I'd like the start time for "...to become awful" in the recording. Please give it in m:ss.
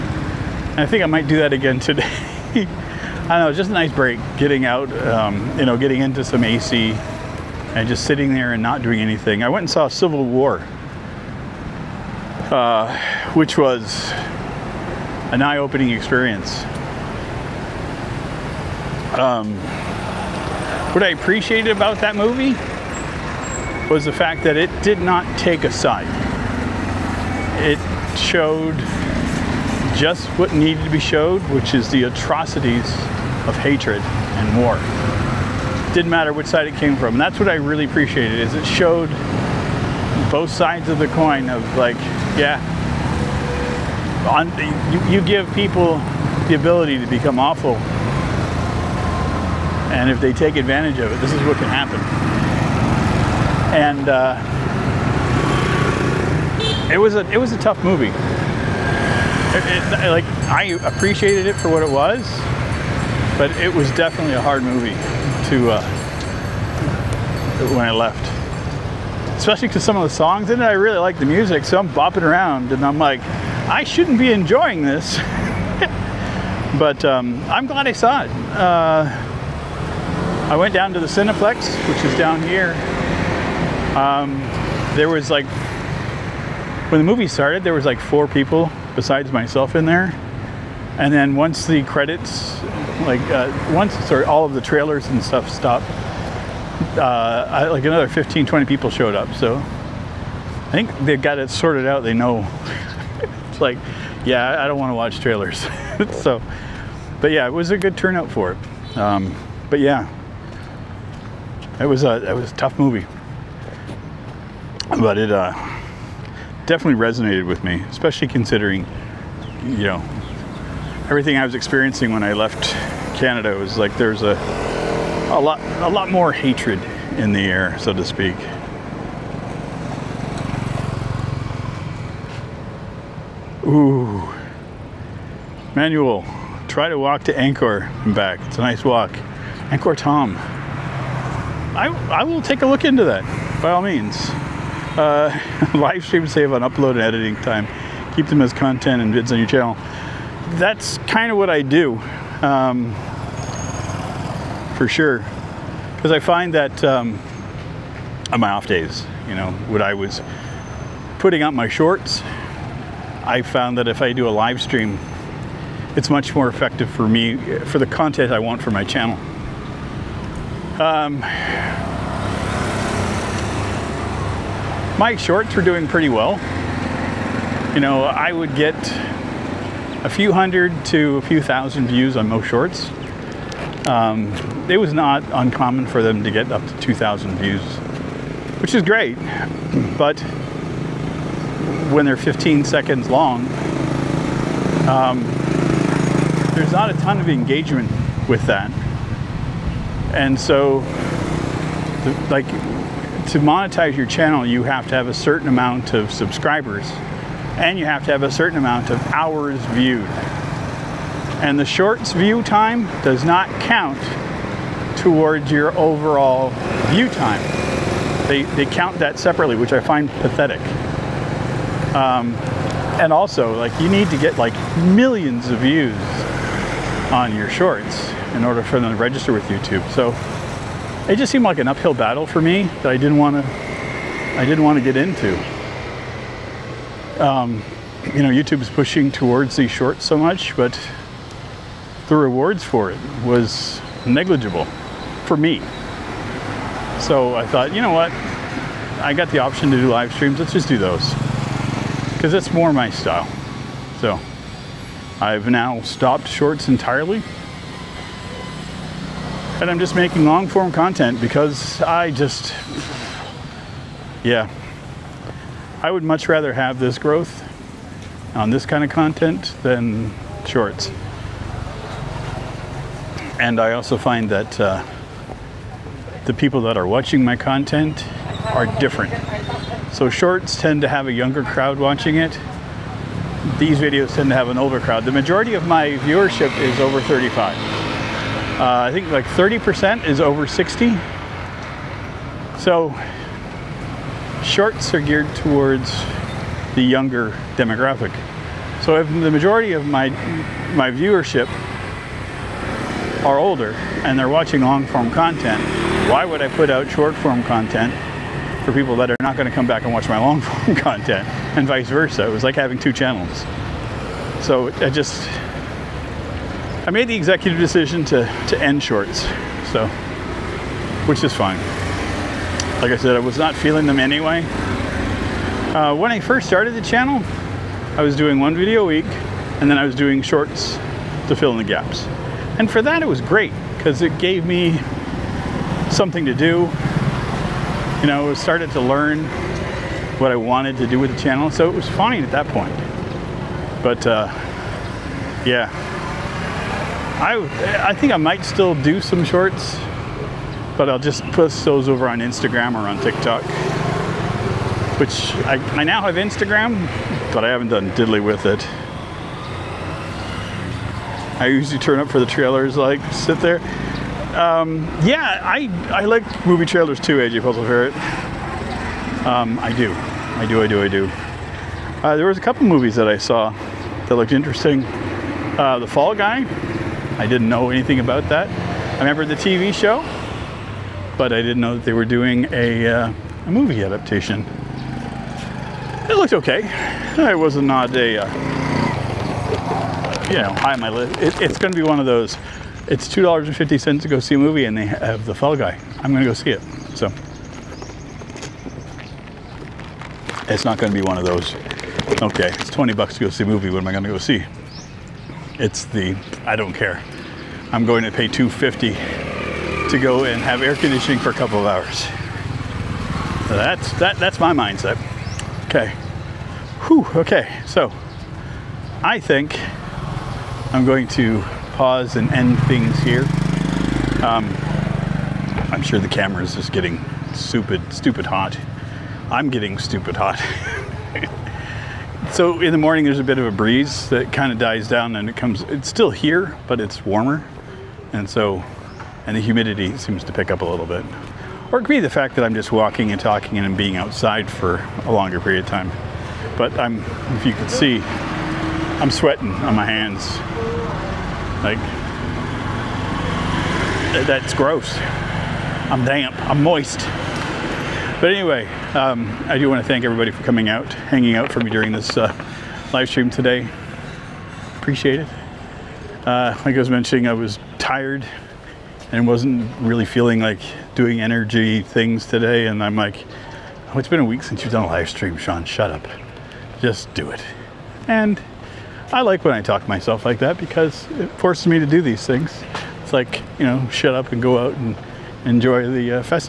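0:46.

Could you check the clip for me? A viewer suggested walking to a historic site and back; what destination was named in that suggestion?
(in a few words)
Angkor Thom.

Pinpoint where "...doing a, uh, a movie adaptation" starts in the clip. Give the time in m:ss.
6:22.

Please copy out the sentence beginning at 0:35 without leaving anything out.
Didn't matter which side it came from.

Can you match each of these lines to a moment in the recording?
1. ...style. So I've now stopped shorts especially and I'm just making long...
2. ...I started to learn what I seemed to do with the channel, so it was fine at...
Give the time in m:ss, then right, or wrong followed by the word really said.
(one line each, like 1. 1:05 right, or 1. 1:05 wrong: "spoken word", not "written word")
1. 4:12 wrong: "entirely", not "especially"
2. 5:38 wrong: "wanted", not "seemed".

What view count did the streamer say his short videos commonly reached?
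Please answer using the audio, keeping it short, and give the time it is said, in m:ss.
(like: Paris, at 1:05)
2,000 views, at 3:06.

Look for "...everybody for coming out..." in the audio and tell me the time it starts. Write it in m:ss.
7:40.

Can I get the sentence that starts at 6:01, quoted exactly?
I usually turn up for the trailers, like sit there.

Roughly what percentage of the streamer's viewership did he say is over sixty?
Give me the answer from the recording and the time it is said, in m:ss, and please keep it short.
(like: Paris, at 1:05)
30%, at 4:49.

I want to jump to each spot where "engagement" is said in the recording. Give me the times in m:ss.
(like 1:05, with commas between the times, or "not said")
3:17.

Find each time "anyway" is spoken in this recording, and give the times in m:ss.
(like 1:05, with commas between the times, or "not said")
5:23, 7:38.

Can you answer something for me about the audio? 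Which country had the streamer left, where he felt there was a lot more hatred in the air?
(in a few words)
Canada.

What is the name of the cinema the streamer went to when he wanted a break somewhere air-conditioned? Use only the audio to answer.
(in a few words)
Cineplex.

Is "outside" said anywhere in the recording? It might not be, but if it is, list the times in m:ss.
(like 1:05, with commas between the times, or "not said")
7:23.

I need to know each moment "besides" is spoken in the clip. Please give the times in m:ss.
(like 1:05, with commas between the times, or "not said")
1:28.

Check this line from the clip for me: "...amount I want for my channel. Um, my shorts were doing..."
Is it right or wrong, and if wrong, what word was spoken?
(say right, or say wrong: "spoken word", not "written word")
wrong: "content", not "amount".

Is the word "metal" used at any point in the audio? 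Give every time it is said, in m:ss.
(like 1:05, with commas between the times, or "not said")
not said.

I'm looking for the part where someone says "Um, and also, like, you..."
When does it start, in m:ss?
3:41.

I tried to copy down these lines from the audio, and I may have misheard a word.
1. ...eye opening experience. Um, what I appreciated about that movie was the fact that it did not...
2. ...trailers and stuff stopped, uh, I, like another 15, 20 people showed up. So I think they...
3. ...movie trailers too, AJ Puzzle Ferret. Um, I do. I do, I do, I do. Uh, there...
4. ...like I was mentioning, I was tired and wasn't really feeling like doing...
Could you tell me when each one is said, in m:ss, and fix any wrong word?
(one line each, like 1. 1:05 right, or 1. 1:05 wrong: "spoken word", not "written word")
1. 0:15 right
2. 1:34 right
3. 6:06 right
4. 7:46 right.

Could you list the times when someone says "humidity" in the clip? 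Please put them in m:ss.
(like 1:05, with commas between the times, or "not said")
7:19.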